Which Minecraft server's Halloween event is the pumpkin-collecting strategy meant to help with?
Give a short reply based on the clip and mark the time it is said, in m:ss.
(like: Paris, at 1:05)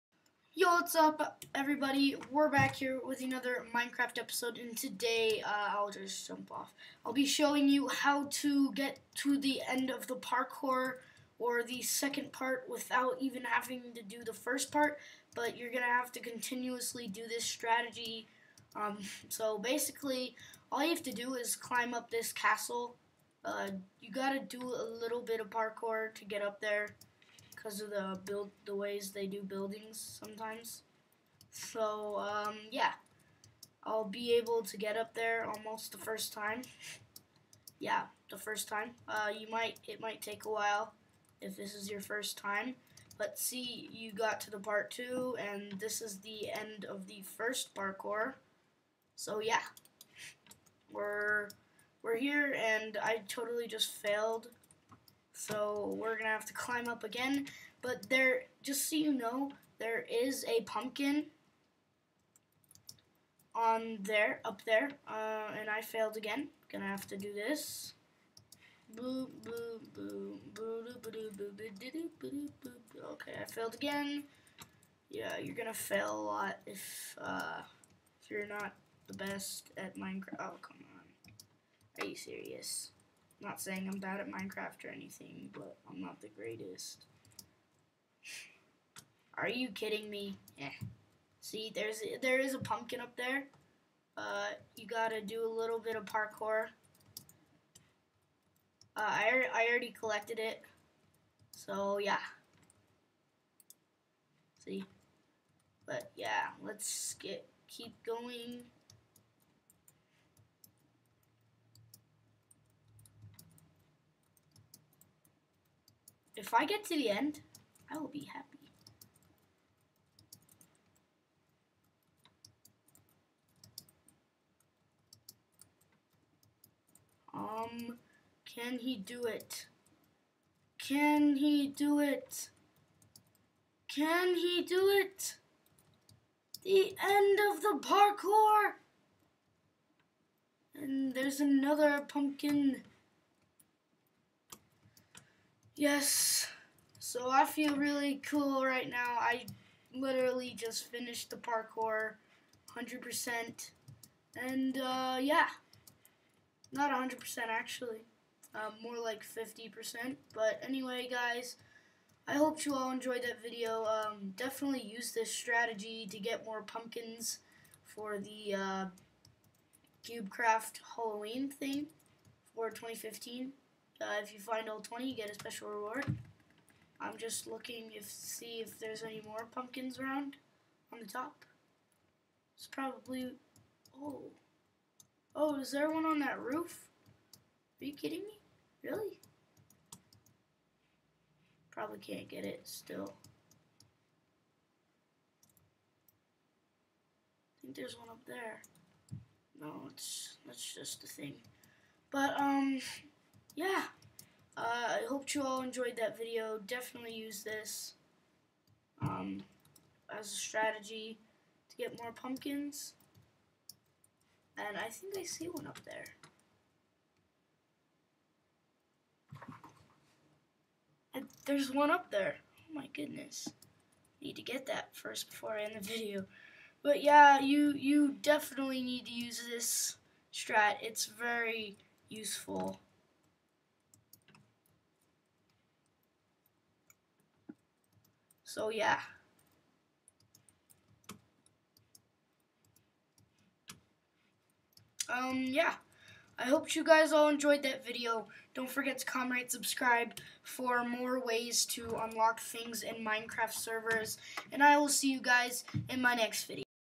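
CubeCraft, at 2:50.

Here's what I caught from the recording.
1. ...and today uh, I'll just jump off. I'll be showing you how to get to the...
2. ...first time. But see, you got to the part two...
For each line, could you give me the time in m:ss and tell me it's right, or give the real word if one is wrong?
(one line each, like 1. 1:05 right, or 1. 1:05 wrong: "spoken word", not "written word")
1. 0:04 right
2. 0:41 right.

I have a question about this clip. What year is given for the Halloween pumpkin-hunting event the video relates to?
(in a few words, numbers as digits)
2015.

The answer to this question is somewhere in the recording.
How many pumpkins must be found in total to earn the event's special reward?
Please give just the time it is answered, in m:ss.
2:54.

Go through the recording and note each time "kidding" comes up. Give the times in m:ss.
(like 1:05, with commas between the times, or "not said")
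1:29, 3:07.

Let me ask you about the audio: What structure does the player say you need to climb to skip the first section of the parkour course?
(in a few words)
Castle.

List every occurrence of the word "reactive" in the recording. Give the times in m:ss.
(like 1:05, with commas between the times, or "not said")
not said.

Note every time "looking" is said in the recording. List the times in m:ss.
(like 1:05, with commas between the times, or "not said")
2:57.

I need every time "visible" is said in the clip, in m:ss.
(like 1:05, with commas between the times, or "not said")
not said.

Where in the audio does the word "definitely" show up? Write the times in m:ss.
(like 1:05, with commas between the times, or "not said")
2:44, 3:26, 3:48.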